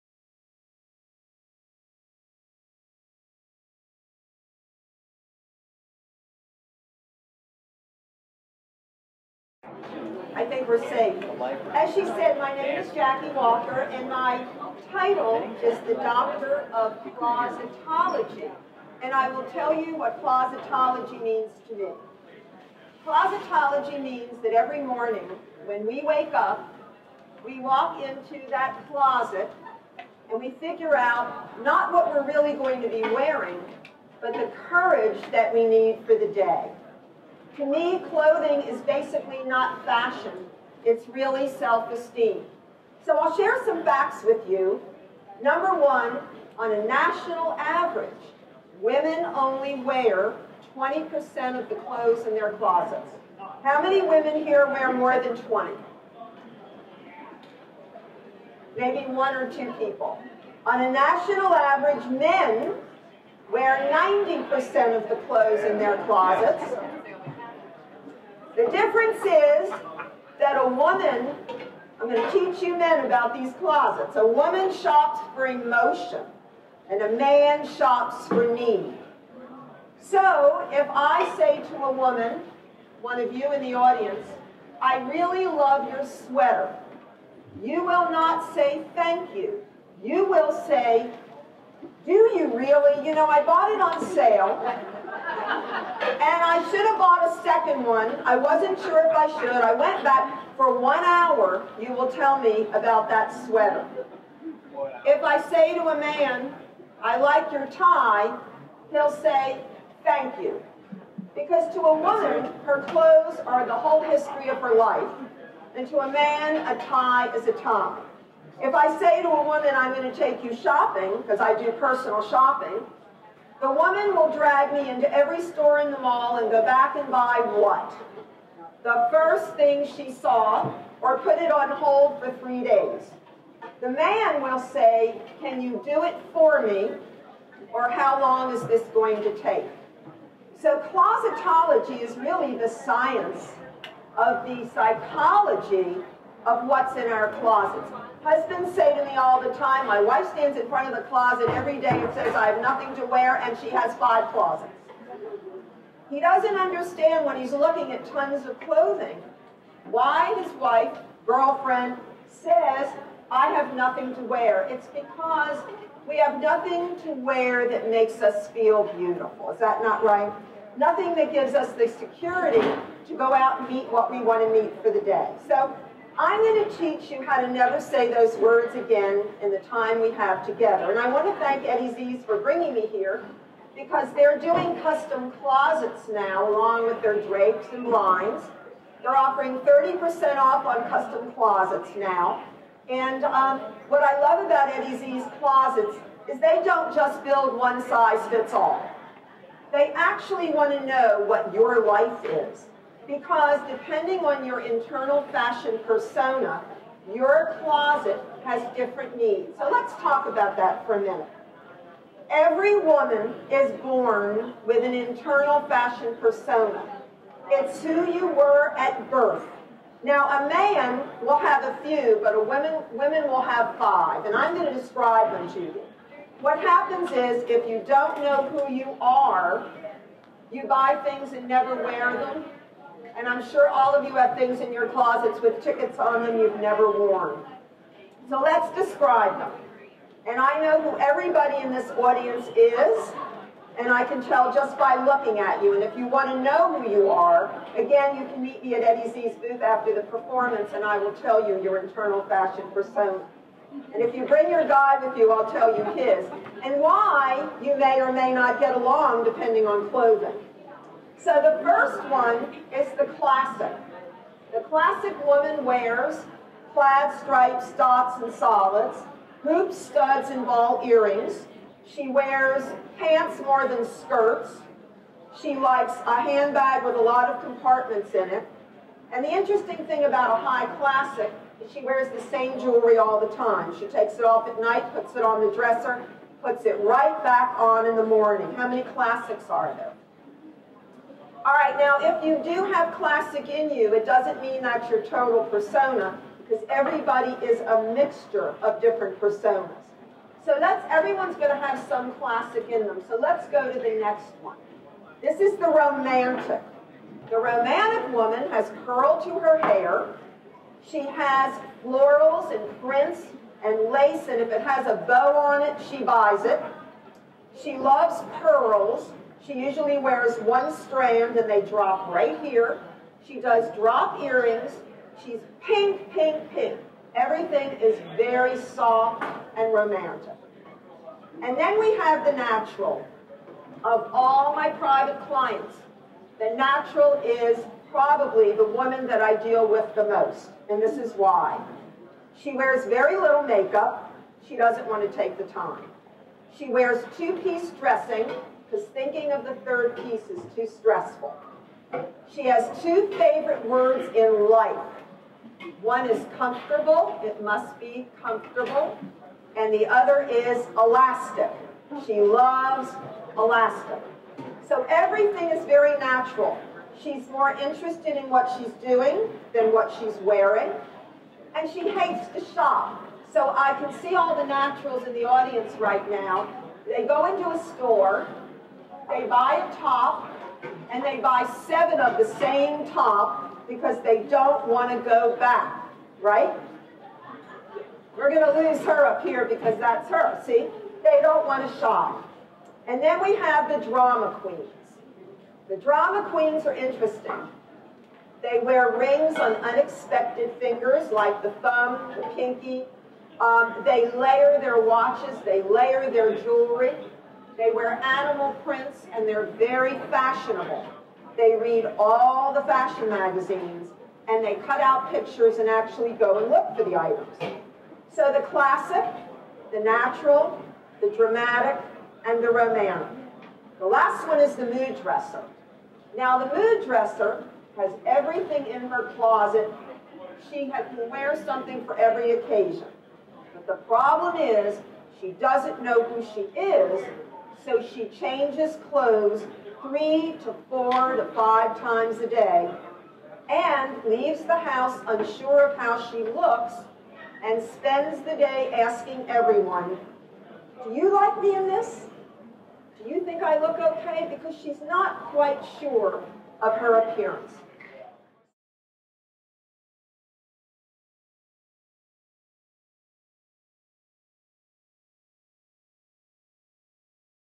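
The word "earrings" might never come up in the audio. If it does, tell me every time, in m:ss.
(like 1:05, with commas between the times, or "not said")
4:30, 5:24.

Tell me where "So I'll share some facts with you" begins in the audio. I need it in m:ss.
0:43.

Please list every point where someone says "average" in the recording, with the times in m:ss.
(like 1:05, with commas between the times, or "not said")
0:47, 1:01.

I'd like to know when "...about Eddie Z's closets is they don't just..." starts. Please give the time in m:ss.
3:14.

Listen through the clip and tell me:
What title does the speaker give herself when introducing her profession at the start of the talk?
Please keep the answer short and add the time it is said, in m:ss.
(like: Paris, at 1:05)
Doctor of Closetology, at 0:15.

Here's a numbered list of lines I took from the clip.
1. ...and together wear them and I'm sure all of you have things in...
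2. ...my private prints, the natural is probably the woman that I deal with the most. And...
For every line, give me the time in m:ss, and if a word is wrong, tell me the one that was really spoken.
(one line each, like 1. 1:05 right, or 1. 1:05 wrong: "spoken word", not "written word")
1. 3:51 wrong: "never", not "together"
2. 5:34 wrong: "clients", not "prints".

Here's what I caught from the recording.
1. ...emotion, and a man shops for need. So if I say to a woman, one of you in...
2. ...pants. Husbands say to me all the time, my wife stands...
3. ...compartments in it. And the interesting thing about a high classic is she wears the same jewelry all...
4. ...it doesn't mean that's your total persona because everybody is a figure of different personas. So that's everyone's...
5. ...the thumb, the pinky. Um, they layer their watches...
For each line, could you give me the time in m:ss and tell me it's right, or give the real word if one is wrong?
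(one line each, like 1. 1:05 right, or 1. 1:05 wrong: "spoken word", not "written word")
1. 1:15 right
2. 2:27 wrong: "closets", not "pants"
3. 4:37 right
4. 4:53 wrong: "mixture", not "figure"
5. 6:41 right.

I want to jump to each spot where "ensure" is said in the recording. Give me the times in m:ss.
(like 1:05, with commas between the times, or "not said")
not said.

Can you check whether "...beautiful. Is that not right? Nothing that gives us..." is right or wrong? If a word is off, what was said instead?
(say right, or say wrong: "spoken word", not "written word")
right.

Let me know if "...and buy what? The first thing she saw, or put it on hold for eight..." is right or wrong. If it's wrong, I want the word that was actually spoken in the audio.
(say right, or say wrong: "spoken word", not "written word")
wrong: "three", not "eight".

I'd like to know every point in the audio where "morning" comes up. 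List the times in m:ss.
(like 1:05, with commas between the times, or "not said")
0:24, 4:48.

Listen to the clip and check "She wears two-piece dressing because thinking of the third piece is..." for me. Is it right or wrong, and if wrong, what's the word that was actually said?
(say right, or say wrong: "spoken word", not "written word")
right.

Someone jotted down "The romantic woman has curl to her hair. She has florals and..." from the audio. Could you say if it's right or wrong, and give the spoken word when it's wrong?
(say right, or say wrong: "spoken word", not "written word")
right.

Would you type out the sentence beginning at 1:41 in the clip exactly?
You will tell me about that sweater.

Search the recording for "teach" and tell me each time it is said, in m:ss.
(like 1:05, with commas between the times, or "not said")
1:12, 2:56.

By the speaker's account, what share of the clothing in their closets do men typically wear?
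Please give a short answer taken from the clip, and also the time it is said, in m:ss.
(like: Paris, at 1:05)
90%, at 1:03.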